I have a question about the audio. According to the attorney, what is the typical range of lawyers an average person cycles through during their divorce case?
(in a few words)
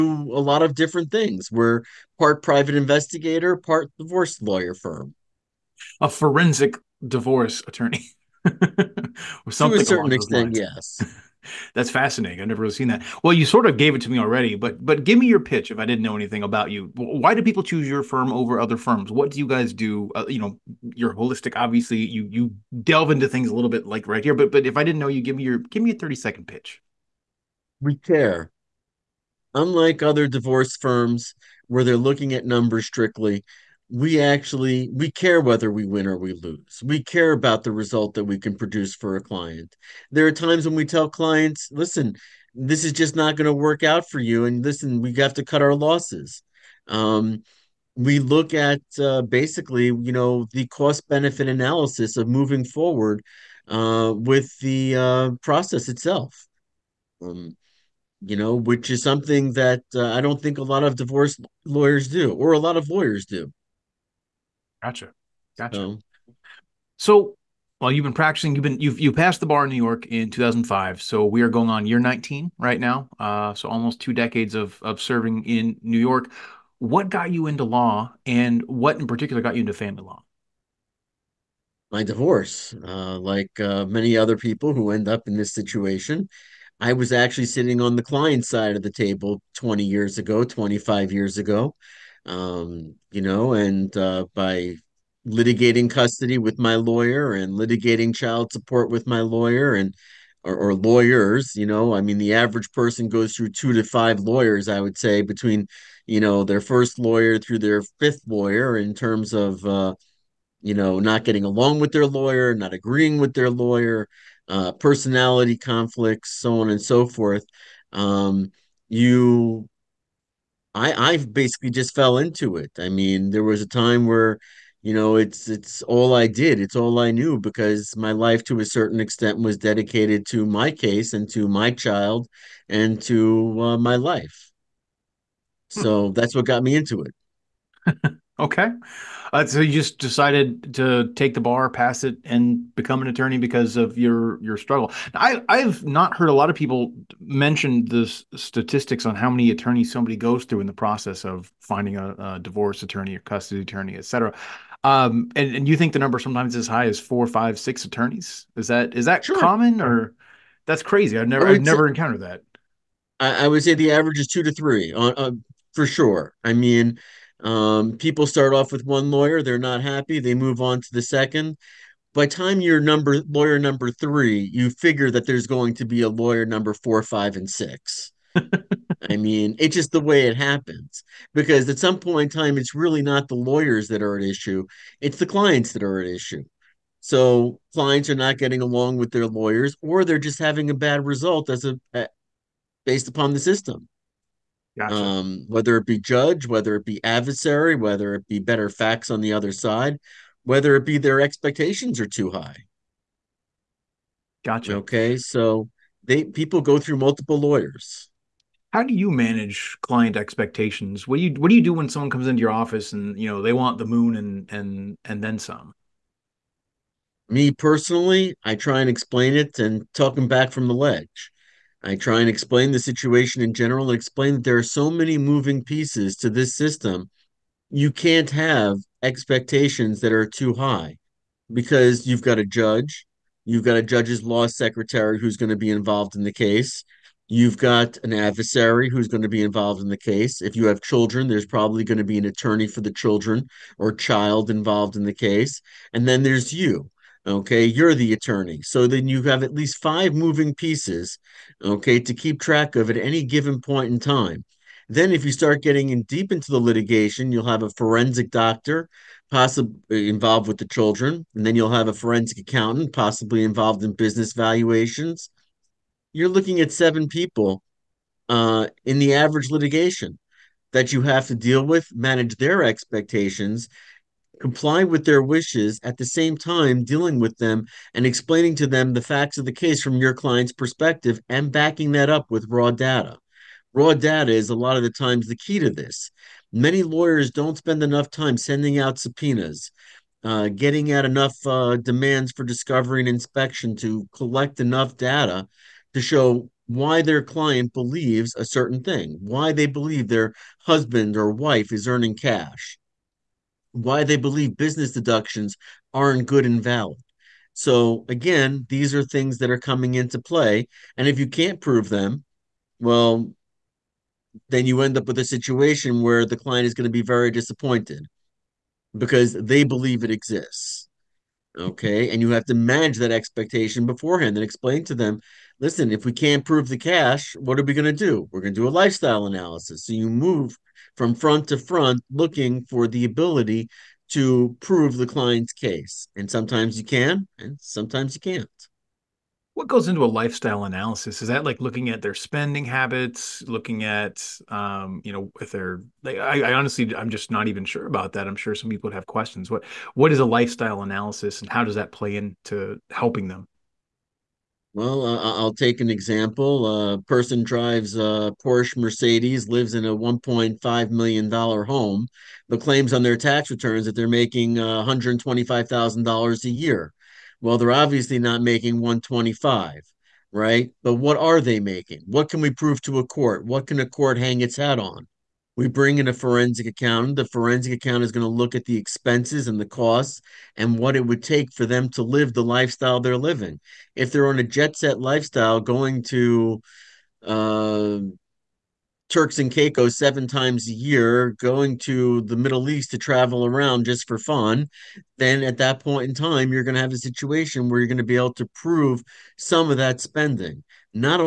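2 to 5.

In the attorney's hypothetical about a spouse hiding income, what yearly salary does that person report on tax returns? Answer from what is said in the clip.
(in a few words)
$125,000.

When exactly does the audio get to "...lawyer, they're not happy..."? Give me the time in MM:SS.
02:49.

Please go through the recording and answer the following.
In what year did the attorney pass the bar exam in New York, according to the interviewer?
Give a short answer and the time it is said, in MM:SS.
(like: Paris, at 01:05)
2005, at 01:10.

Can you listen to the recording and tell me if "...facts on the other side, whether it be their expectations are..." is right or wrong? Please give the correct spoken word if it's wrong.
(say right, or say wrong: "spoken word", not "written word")
right.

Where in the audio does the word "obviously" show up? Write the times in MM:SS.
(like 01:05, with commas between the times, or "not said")
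00:21, 06:07.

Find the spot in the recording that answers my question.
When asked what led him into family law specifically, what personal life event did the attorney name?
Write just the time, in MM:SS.
01:21.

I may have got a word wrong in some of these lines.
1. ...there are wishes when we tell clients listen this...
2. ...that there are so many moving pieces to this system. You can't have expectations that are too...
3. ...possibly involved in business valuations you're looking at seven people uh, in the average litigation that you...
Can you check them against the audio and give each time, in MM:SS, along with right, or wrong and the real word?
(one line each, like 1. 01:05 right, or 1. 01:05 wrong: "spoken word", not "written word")
1. 00:40 wrong: "times", not "wishes"
2. 03:44 right
3. 04:22 right.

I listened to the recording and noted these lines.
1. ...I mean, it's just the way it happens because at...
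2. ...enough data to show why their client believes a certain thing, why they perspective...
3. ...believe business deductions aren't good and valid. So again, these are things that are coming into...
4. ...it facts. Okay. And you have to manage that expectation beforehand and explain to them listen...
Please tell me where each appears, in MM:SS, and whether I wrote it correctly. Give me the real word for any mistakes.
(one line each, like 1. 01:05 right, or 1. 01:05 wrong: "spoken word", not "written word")
1. 02:59 right
2. 04:54 wrong: "believe", not "perspective"
3. 05:04 right
4. 05:20 wrong: "exists", not "facts".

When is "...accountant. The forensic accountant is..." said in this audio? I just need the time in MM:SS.
06:16.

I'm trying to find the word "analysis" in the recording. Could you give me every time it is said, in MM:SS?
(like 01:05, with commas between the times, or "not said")
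00:51, 05:29, 05:40, 05:50.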